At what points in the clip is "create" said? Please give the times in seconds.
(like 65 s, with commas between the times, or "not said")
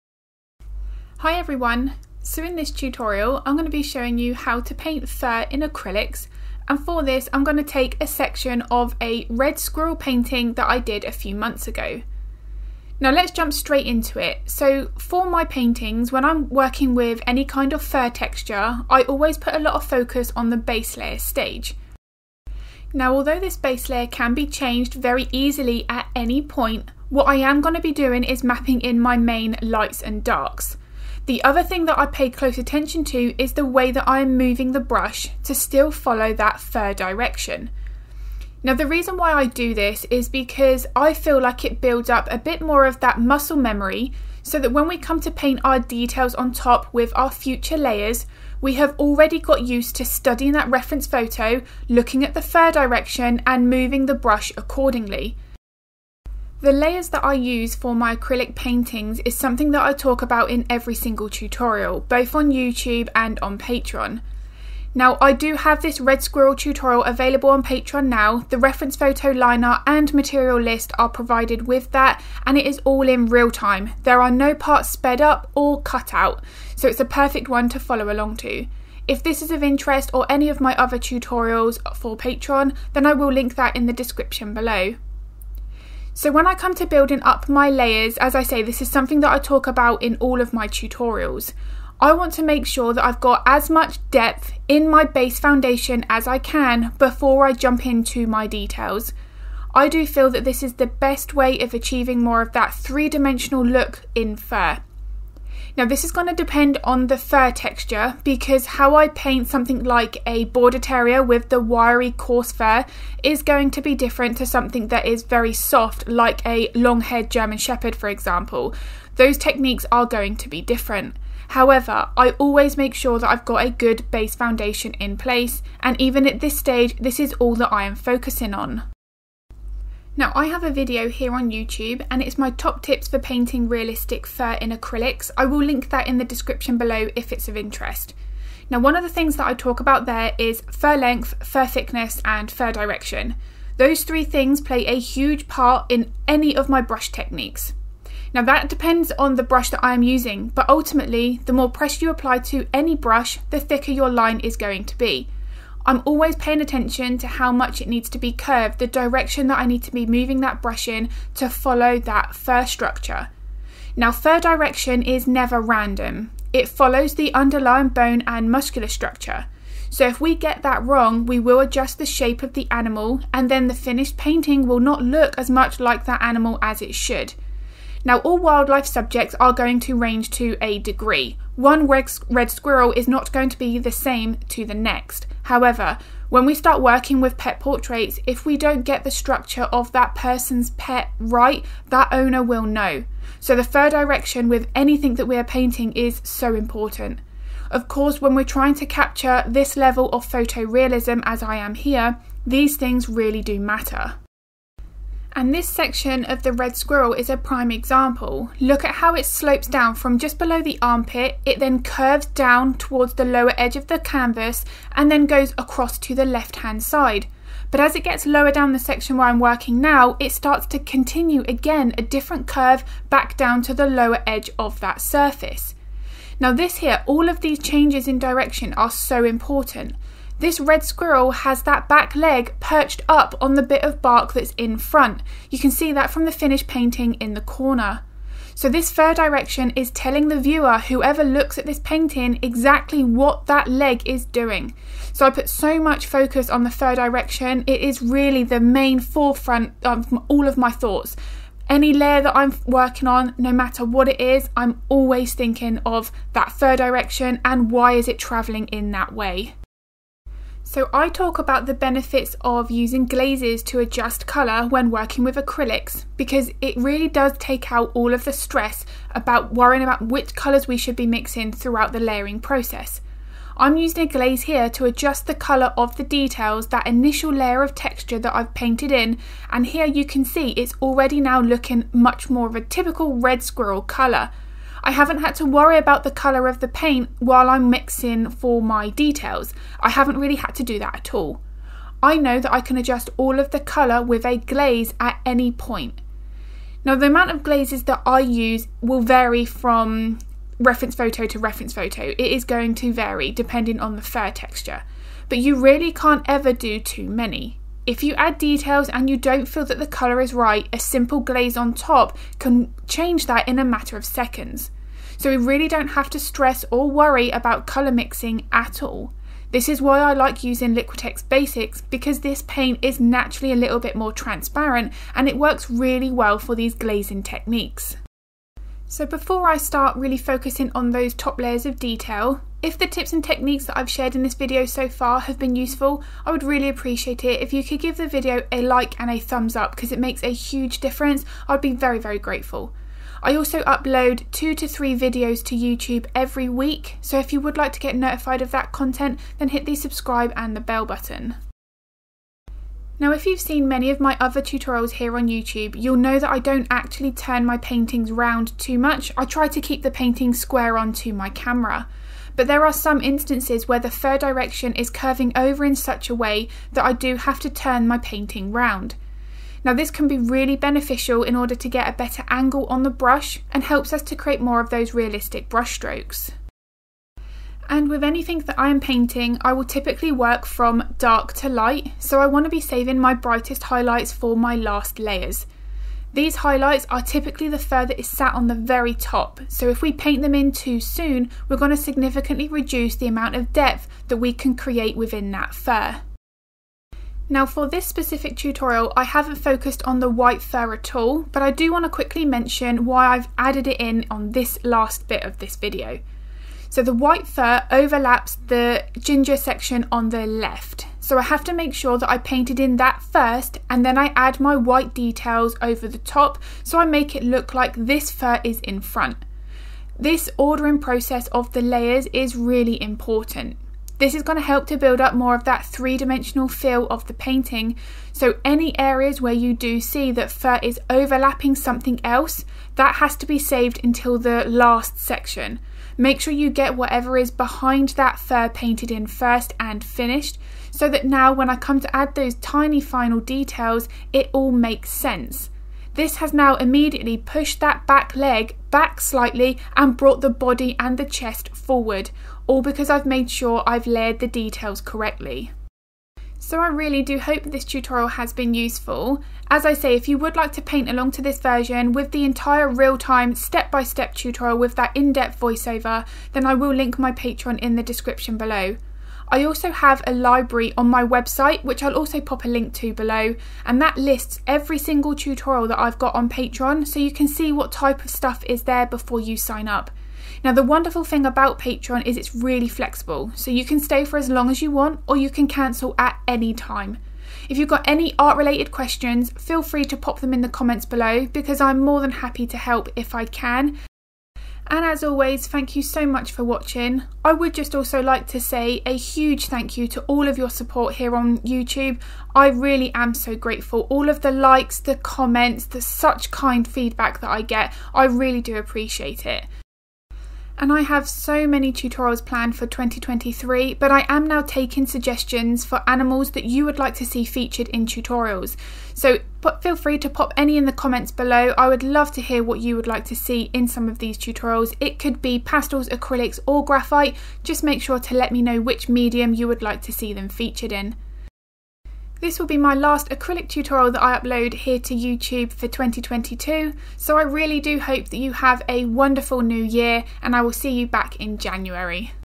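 374 s, 394 s.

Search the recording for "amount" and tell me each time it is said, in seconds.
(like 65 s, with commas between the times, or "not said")
297 s, 393 s.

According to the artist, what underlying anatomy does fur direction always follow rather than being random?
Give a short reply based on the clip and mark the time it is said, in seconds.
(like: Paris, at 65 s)
Bone and muscular structure, at 167 s.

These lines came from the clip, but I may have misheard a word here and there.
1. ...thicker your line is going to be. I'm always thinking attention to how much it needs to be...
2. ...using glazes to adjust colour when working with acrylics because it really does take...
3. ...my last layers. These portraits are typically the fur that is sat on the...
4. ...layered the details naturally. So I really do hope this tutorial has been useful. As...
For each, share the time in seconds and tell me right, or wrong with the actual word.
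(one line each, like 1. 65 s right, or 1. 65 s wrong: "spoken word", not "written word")
1. 153 s wrong: "paying", not "thinking"
2. 262 s right
3. 384 s wrong: "highlights", not "portraits"
4. 453 s wrong: "correctly", not "naturally".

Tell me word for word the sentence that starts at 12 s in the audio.
Now let's jump straight into it.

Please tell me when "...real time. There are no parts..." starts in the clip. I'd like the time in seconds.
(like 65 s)
73 s.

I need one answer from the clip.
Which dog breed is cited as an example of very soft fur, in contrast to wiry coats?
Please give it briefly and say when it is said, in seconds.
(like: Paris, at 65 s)
Long-haired German Shepherd, at 116 s.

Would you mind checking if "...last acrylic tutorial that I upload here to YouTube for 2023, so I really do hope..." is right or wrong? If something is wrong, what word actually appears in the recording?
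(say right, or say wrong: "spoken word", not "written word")
wrong: "2022", not "2023".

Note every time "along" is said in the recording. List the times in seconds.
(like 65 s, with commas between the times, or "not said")
78 s, 460 s.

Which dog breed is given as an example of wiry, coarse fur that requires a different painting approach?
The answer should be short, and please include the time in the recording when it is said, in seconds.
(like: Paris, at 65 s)
Border terrier, at 110 s.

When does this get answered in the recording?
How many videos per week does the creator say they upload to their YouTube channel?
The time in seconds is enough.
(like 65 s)
344 s.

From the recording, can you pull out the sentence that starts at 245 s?
So I put so much focus on the fur direction.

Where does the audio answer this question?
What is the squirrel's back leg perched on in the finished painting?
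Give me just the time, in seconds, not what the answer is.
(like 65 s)
234 s.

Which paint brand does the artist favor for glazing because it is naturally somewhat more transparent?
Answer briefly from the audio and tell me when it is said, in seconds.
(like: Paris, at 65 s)
Liquitex Basics, at 320 s.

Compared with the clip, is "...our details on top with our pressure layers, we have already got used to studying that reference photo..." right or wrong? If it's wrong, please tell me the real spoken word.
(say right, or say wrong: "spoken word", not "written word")
wrong: "future", not "pressure".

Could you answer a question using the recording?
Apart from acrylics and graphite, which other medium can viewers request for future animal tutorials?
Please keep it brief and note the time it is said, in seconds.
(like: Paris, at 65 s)
Pastels, at 525 s.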